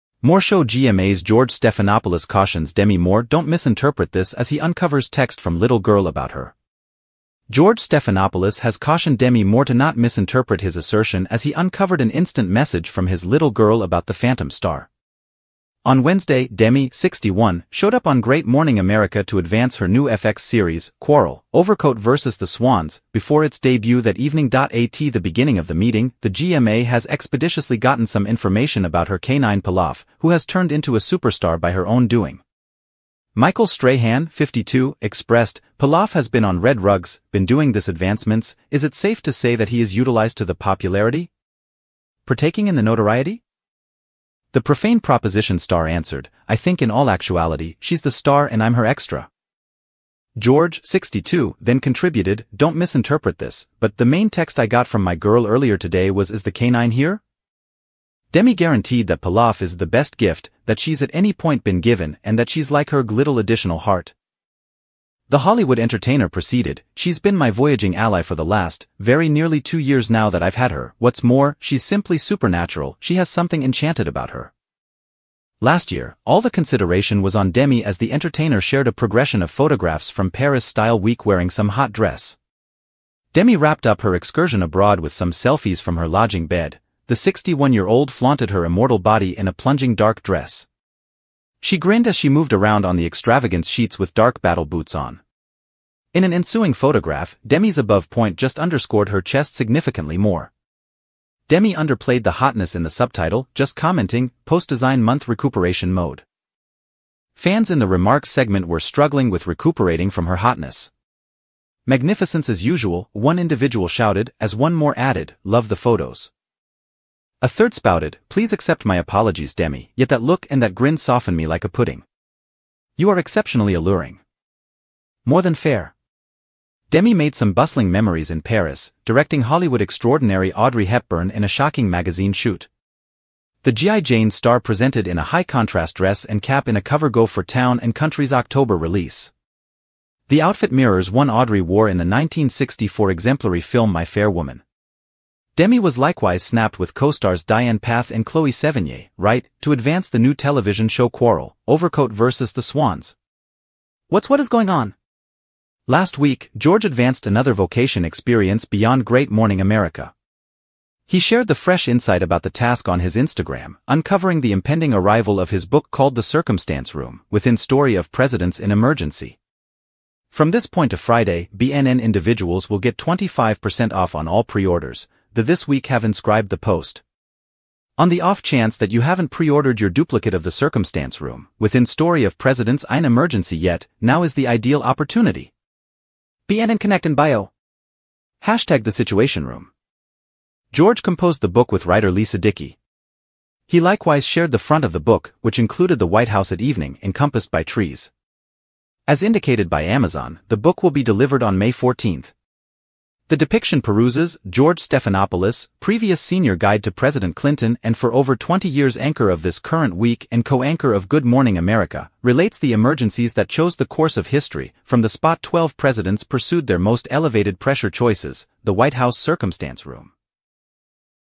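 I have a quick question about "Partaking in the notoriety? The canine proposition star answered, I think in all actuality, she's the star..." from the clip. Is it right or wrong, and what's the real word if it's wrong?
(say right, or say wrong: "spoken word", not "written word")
wrong: "profane", not "canine".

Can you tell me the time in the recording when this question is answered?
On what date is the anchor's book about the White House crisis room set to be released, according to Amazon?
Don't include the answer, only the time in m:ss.
3:21.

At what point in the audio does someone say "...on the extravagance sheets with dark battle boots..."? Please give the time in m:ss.
1:32.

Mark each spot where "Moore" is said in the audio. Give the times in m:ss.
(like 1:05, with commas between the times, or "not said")
0:02, 0:09.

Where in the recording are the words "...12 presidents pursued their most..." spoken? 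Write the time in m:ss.
3:35.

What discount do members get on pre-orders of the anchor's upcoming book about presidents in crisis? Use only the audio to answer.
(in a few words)
25%.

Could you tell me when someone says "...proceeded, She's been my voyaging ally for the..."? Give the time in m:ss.
1:06.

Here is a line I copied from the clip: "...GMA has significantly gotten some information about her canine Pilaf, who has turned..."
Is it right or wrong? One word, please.
wrong.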